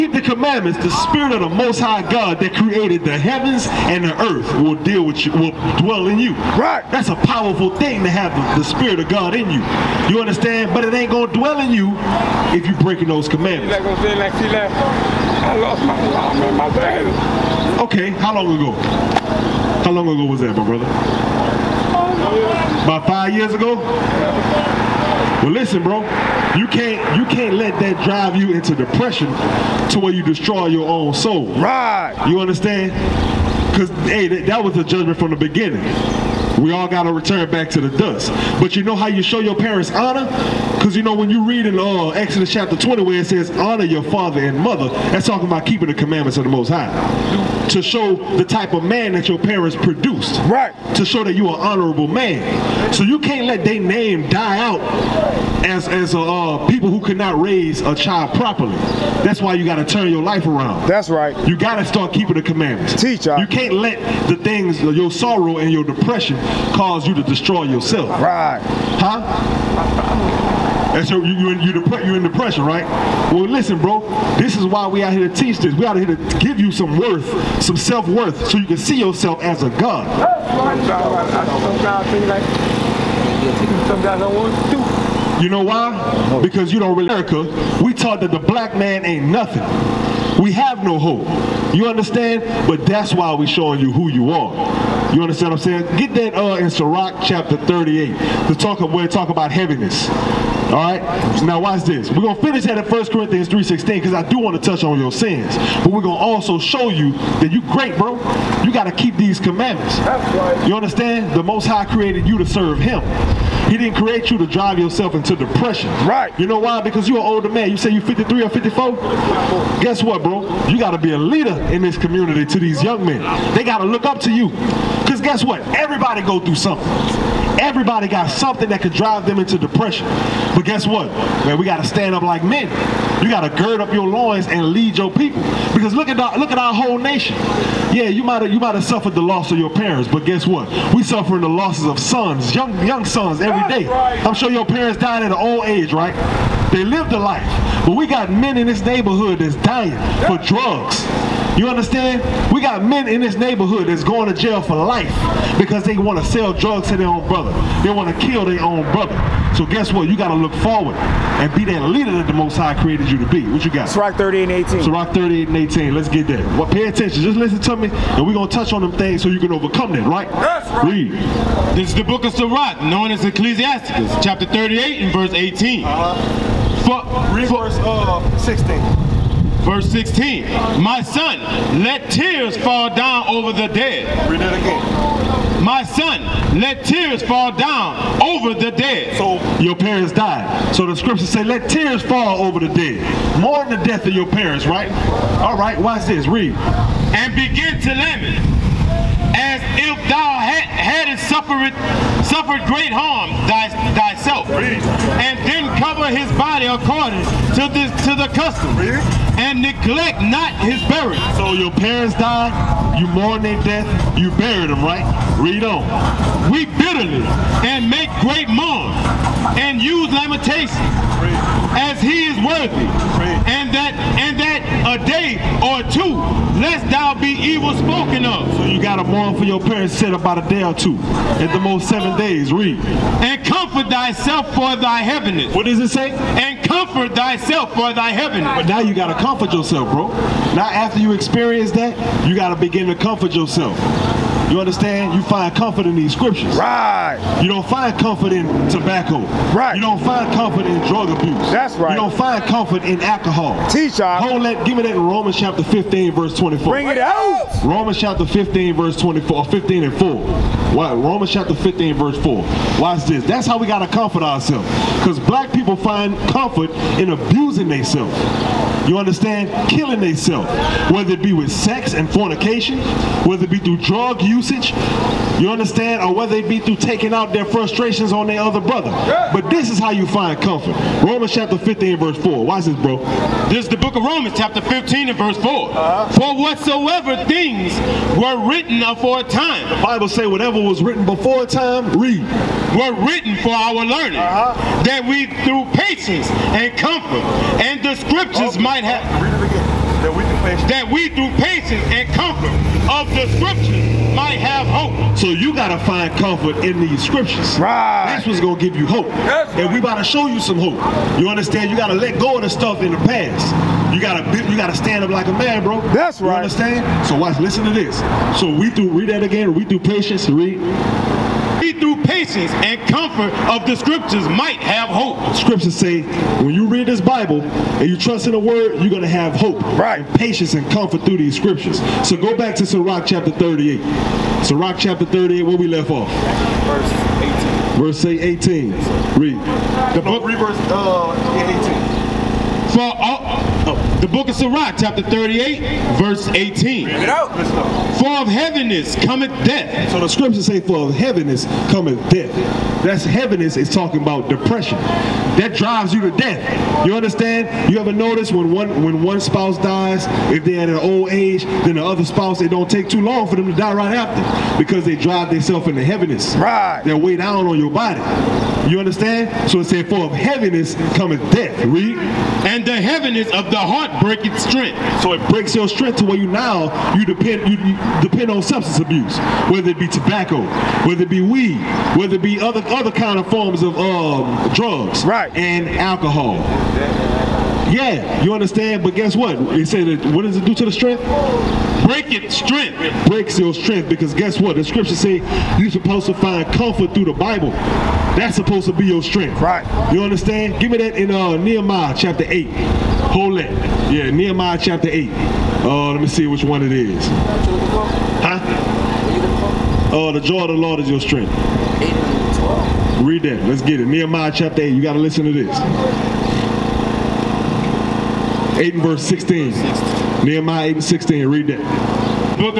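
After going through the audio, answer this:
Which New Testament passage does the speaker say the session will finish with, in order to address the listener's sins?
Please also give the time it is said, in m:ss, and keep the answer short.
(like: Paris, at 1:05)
1 Corinthians 3:16, at 1:42.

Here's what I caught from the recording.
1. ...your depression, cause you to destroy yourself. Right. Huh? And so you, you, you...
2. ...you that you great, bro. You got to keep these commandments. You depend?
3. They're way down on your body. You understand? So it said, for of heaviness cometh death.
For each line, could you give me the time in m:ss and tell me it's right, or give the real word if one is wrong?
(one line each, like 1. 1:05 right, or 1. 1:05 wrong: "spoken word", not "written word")
1. 1:05 right
2. 1:46 wrong: "understand", not "depend"
3. 6:06 right.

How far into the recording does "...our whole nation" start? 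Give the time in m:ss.
2:16.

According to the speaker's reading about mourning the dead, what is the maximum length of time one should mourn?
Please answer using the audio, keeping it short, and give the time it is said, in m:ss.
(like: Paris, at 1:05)
7 days, at 3:51.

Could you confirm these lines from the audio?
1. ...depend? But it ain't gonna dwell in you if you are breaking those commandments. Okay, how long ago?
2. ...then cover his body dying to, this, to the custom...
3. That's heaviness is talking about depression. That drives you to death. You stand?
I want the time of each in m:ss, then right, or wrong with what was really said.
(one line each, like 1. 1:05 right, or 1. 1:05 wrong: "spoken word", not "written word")
1. 0:10 wrong: "understand", not "depend"
2. 3:25 wrong: "according", not "dying"
3. 5:52 wrong: "understand", not "stand".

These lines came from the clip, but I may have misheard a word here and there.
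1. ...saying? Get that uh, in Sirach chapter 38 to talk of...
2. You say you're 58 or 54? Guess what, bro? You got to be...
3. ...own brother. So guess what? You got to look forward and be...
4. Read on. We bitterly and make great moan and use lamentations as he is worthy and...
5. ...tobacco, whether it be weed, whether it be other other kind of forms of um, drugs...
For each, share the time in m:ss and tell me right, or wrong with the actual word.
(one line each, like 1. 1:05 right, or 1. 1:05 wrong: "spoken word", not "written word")
1. 1:35 right
2. 1:57 wrong: "53", not "58"
3. 2:38 right
4. 3:35 right
5. 6:19 right.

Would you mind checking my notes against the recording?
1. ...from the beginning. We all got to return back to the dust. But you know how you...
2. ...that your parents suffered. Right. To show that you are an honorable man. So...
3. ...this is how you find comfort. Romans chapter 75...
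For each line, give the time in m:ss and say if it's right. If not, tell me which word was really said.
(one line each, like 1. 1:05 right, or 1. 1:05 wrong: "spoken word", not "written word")
1. 0:35 right
2. 0:49 wrong: "produced", not "suffered"
3. 4:39 wrong: "15", not "75".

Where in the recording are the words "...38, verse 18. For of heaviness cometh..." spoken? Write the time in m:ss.
5:45.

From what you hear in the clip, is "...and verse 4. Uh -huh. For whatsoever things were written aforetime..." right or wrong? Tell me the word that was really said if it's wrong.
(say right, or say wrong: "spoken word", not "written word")
right.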